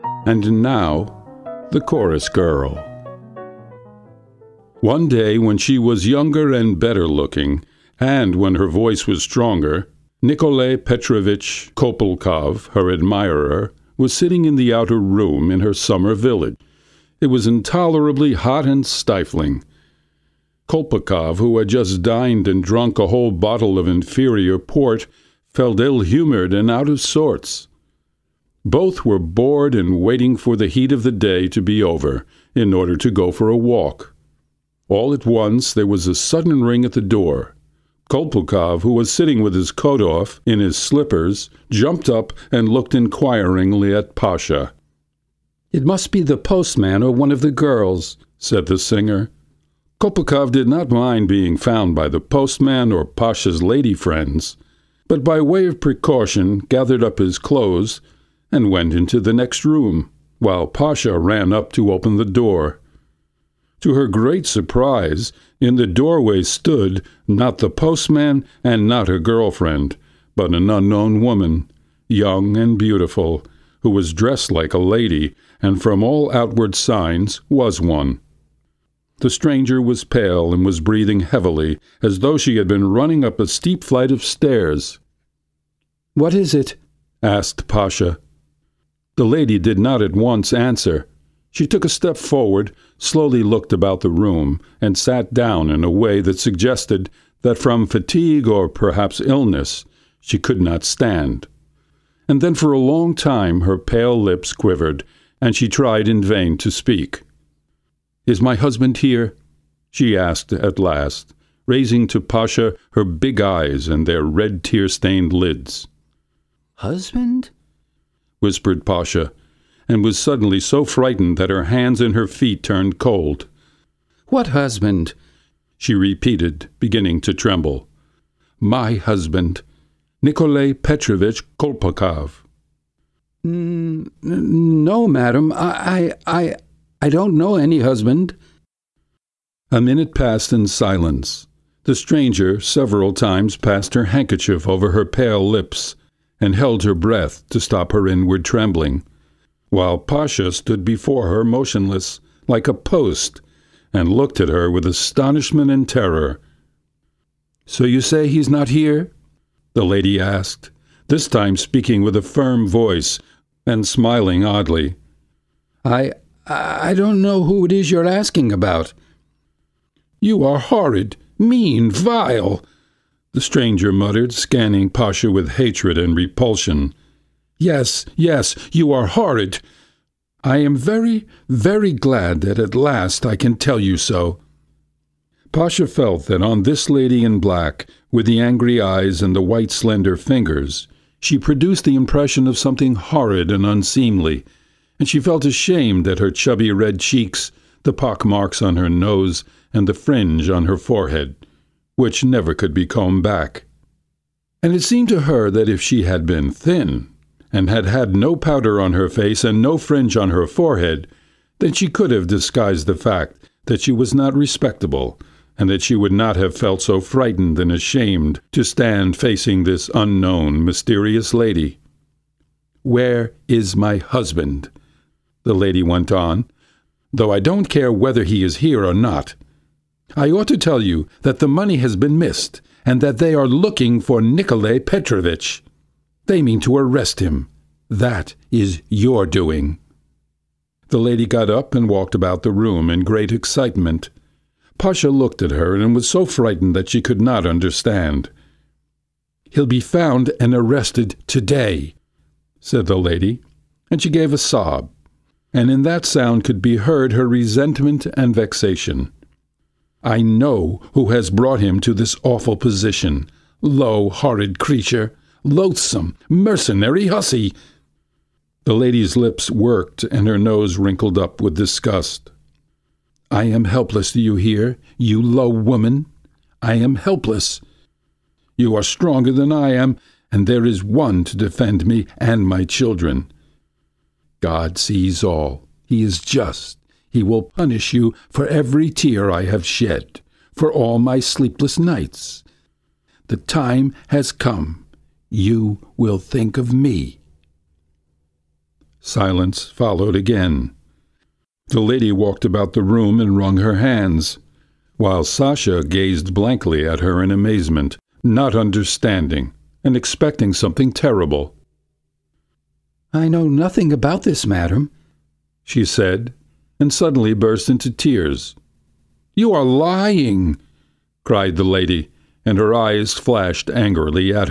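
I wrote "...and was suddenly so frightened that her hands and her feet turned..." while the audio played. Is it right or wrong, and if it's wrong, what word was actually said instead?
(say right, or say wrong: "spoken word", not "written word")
right.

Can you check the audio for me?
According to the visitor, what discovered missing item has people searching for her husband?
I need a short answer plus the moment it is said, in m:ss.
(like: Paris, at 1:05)
The money, at 3:51.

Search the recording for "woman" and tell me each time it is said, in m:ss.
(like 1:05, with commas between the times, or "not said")
1:11, 4:35.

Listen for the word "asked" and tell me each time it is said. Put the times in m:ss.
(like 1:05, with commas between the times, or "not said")
1:27, 1:50, 2:40.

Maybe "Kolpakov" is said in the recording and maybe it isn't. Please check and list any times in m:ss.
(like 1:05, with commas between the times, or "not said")
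0:11, 0:20, 0:38, 0:50, 2:11.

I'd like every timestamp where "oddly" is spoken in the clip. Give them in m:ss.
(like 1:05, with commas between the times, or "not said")
2:44.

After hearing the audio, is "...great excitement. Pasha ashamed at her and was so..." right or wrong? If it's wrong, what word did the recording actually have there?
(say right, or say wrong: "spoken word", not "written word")
wrong: "looked", not "ashamed".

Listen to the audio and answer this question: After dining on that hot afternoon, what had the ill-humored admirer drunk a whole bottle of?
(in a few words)
Inferior port.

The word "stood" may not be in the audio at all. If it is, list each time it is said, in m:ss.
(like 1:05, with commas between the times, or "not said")
1:06, 2:30.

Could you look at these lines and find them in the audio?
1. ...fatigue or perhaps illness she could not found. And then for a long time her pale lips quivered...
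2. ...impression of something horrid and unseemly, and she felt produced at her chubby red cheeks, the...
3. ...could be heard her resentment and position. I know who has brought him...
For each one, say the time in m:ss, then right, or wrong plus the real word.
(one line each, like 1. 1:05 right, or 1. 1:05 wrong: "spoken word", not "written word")
1. 1:37 wrong: "stand", not "found"
2. 3:11 wrong: "ashamed", not "produced"
3. 4:16 wrong: "vexation", not "position".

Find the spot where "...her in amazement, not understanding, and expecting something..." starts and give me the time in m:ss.
5:07.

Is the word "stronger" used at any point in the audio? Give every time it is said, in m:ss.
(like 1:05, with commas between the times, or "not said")
0:09, 4:38.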